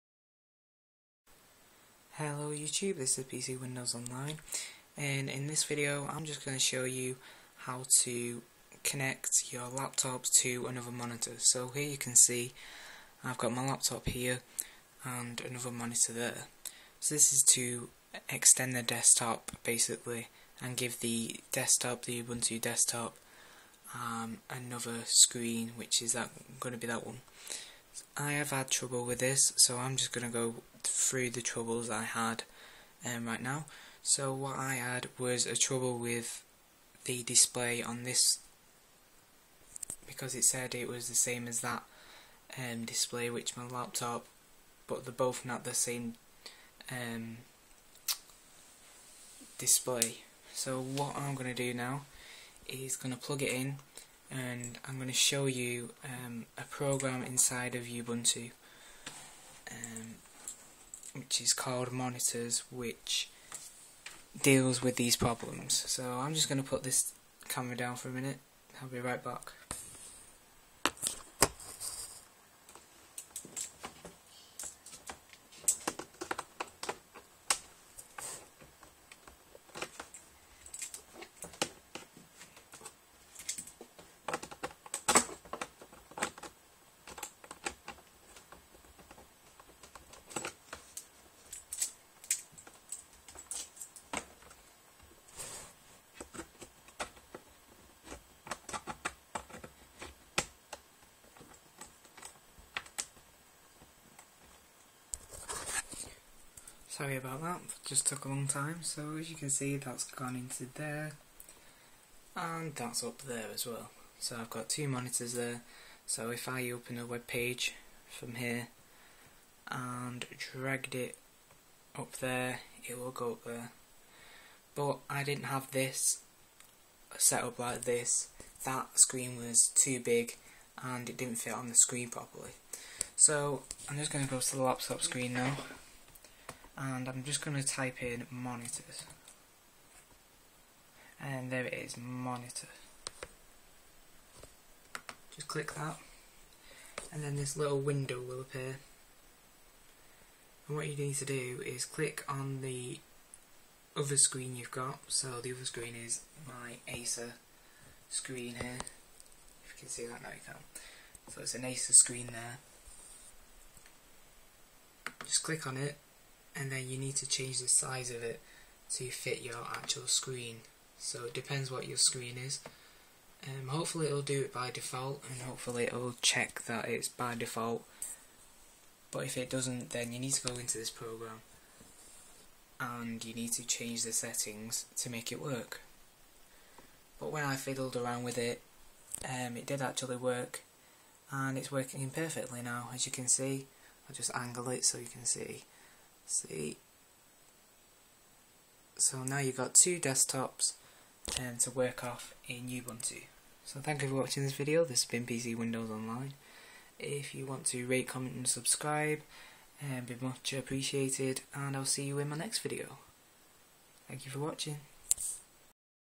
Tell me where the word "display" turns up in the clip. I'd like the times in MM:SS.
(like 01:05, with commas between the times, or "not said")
00:37, 00:42, 00:49.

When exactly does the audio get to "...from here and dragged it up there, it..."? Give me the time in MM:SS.
01:58.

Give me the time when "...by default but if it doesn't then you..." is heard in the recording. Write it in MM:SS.
02:57.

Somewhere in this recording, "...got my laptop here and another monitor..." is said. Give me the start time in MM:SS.
00:13.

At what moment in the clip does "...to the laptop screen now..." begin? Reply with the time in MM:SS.
02:14.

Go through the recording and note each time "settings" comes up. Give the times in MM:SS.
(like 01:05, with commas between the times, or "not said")
03:04.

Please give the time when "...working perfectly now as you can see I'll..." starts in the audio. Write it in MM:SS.
03:11.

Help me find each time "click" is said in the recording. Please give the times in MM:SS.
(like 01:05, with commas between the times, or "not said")
02:25, 02:31, 02:45.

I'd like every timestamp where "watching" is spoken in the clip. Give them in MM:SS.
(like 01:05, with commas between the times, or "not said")
03:24, 03:34.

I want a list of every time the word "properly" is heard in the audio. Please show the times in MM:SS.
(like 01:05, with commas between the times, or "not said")
02:12.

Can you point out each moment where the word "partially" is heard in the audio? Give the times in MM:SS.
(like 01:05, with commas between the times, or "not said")
not said.